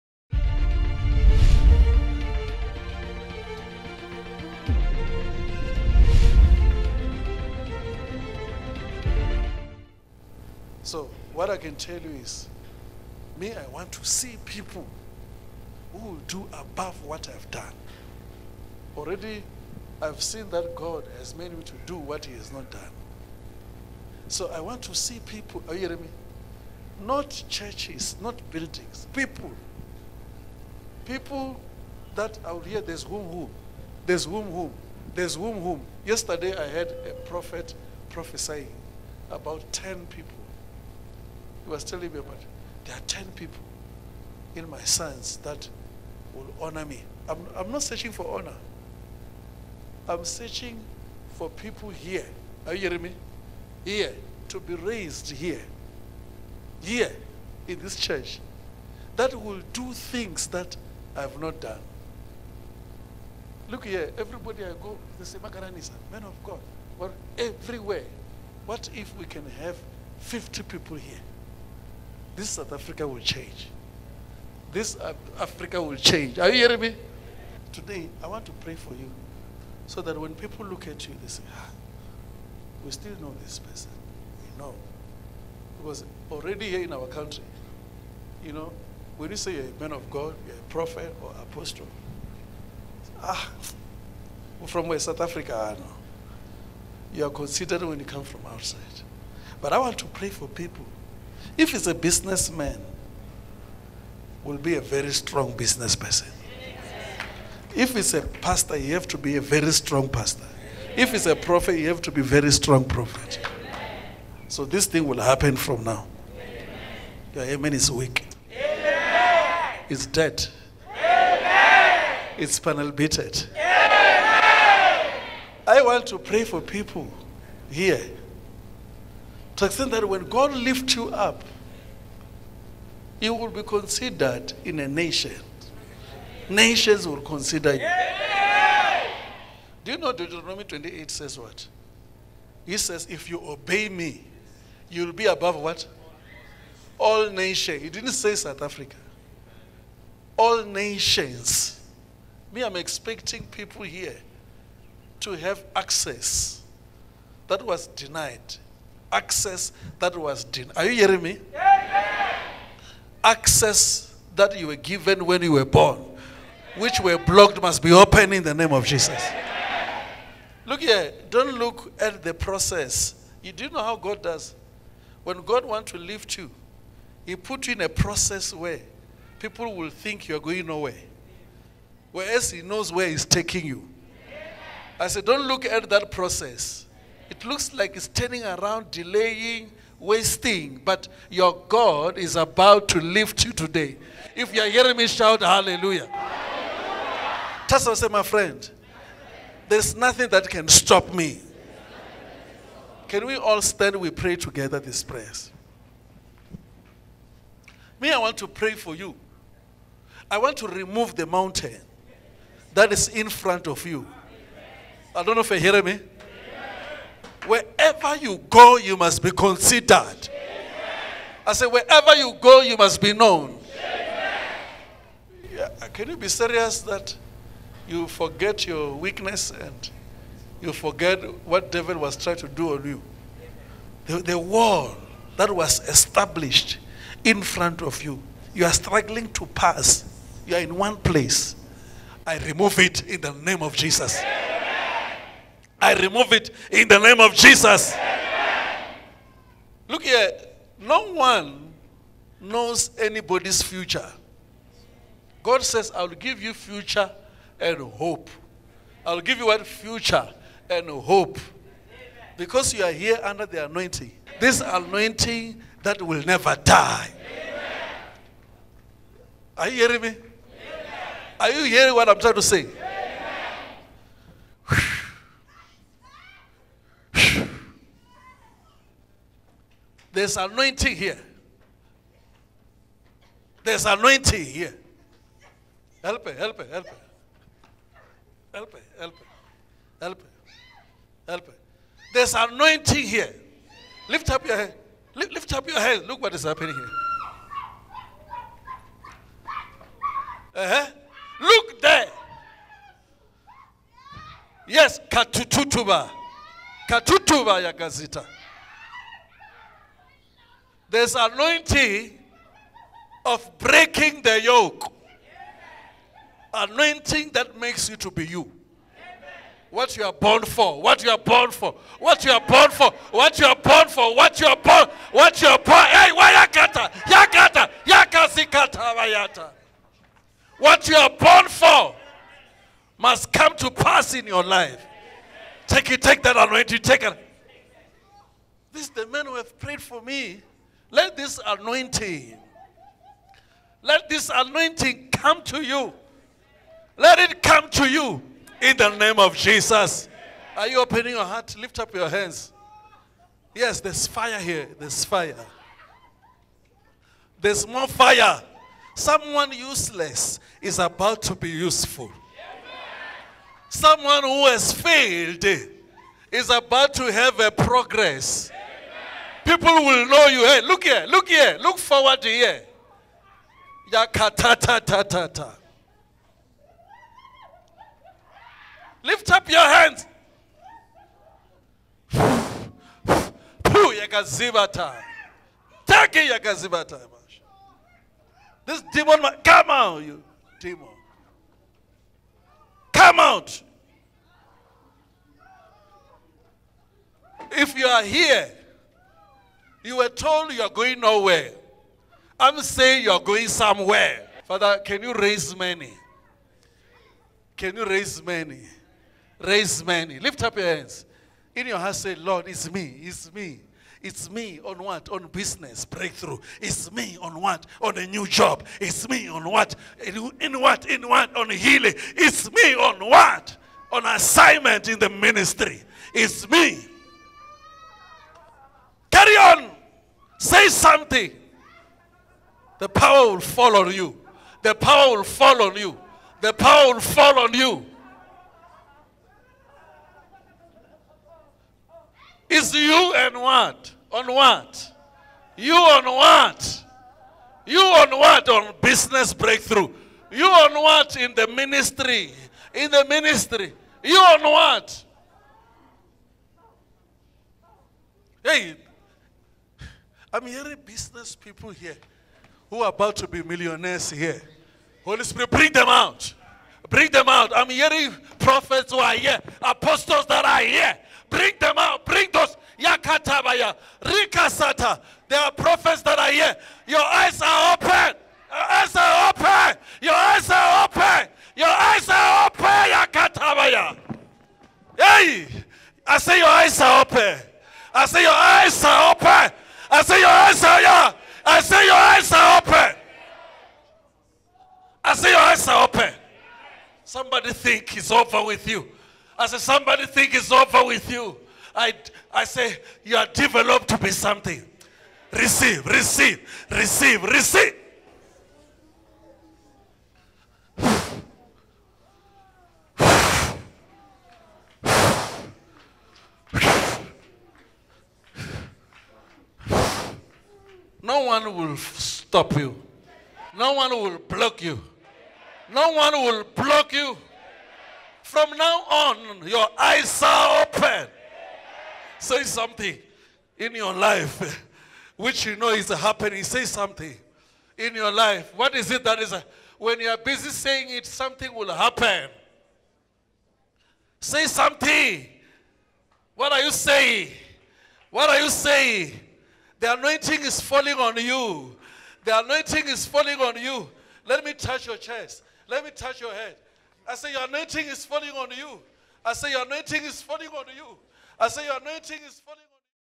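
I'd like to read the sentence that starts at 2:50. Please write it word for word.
Look here, don't look at the process.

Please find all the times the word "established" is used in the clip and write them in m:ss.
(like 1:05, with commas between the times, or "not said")
3:55.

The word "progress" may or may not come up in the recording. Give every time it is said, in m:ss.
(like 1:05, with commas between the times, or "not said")
6:07.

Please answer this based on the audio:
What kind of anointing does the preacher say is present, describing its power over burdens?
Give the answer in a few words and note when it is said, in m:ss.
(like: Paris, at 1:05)
breaking the yoke, at 5:13.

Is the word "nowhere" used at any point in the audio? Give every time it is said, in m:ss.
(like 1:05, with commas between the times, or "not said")
3:00, 6:40.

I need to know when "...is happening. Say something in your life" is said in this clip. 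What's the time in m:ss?
8:55.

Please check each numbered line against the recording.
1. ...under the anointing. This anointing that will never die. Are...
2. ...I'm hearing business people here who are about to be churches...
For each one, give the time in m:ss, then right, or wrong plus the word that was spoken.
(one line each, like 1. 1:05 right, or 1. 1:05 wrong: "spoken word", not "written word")
1. 4:23 right
2. 7:40 wrong: "millionaires", not "churches".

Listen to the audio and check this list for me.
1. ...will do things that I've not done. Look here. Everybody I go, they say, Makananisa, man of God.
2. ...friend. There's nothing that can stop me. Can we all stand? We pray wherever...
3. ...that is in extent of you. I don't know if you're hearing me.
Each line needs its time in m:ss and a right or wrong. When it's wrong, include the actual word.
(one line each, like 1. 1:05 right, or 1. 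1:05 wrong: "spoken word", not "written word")
1. 0:59 right
2. 3:18 wrong: "together", not "wherever"
3. 3:32 wrong: "front", not "extent".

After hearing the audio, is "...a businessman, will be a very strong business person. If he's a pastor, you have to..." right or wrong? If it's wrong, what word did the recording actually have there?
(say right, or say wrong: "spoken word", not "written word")
right.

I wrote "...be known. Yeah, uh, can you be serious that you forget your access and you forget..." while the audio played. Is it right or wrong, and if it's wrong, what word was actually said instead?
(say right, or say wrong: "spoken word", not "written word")
wrong: "weakness", not "access".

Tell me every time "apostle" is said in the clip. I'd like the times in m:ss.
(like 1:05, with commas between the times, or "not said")
1:31, 7:49.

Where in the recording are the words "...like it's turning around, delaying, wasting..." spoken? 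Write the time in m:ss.
3:07.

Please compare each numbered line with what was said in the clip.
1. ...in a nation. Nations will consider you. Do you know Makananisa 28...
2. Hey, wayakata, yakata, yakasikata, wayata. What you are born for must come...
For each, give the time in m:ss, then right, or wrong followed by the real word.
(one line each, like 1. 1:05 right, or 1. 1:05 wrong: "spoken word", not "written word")
1. 2:14 wrong: "Deuteronomy", not "Makananisa"
2. 5:25 right.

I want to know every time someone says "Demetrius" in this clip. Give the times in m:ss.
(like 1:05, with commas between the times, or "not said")
not said.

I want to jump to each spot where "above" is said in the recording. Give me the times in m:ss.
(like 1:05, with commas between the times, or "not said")
0:16, 2:25.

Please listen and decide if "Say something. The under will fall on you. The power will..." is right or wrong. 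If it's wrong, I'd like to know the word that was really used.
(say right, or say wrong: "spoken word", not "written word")
wrong: "power", not "under".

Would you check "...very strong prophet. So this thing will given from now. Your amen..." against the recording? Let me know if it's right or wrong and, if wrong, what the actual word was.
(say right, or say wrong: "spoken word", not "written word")
wrong: "happen", not "given".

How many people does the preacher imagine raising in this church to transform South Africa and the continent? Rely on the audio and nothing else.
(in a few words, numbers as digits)
50.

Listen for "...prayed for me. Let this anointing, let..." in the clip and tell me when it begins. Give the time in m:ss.
5:39.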